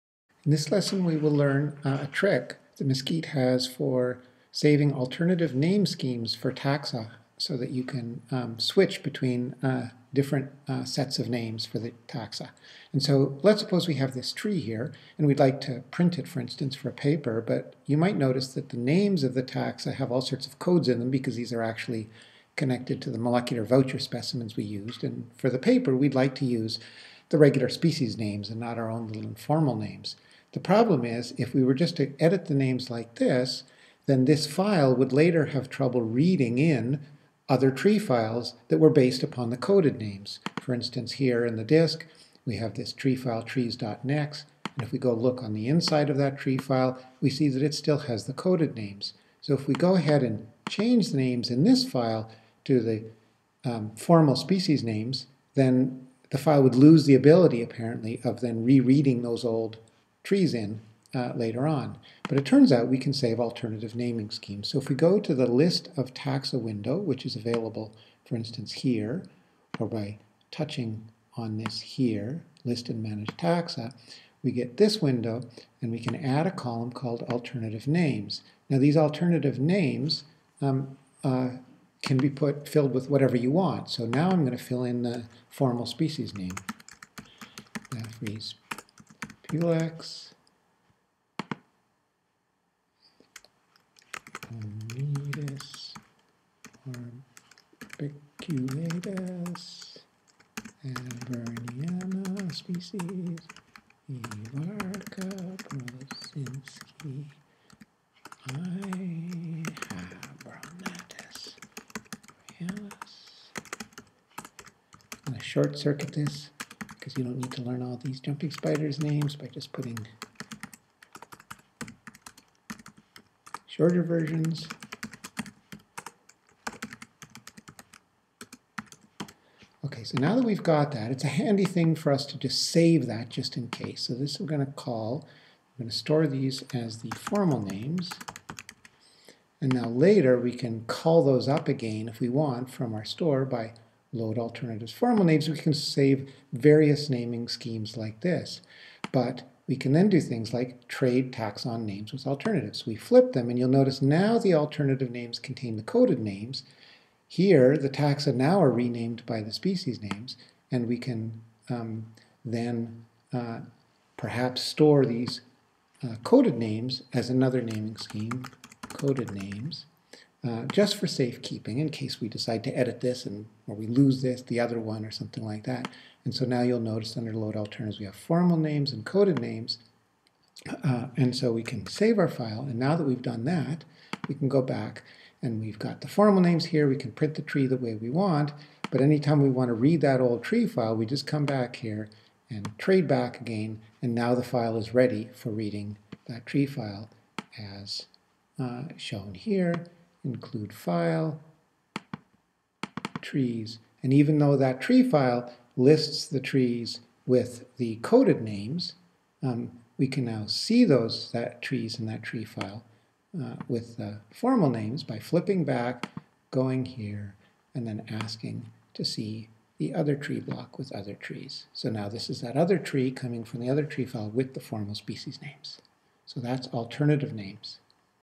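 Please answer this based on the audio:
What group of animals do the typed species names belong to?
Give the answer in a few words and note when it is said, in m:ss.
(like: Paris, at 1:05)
jumping spiders, at 1:58.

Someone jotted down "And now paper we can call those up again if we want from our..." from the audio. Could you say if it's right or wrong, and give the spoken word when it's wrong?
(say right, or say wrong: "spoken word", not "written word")
wrong: "later", not "paper".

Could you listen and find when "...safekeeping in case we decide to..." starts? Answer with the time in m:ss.
2:51.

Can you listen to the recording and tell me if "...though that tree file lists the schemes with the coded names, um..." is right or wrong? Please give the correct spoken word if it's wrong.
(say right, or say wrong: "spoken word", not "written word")
wrong: "trees", not "schemes".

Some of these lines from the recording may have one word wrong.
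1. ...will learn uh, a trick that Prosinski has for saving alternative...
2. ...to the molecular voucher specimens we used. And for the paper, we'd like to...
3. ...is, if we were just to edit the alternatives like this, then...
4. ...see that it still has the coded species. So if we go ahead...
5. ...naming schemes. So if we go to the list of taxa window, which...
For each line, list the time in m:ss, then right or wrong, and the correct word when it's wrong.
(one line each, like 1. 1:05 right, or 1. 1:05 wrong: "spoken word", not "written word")
1. 0:01 wrong: "Mesquite", not "Prosinski"
2. 0:23 right
3. 0:31 wrong: "names", not "alternatives"
4. 0:47 wrong: "names", not "species"
5. 1:03 right.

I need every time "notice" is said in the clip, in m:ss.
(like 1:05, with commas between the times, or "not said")
0:18, 2:33, 2:56.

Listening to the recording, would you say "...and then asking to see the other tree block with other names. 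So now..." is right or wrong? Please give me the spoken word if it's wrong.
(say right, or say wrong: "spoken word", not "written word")
wrong: "trees", not "names".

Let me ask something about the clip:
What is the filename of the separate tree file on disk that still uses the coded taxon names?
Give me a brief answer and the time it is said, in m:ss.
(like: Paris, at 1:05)
trees.nex, at 0:43.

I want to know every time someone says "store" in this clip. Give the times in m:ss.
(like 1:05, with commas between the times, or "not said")
2:15, 2:23, 2:44.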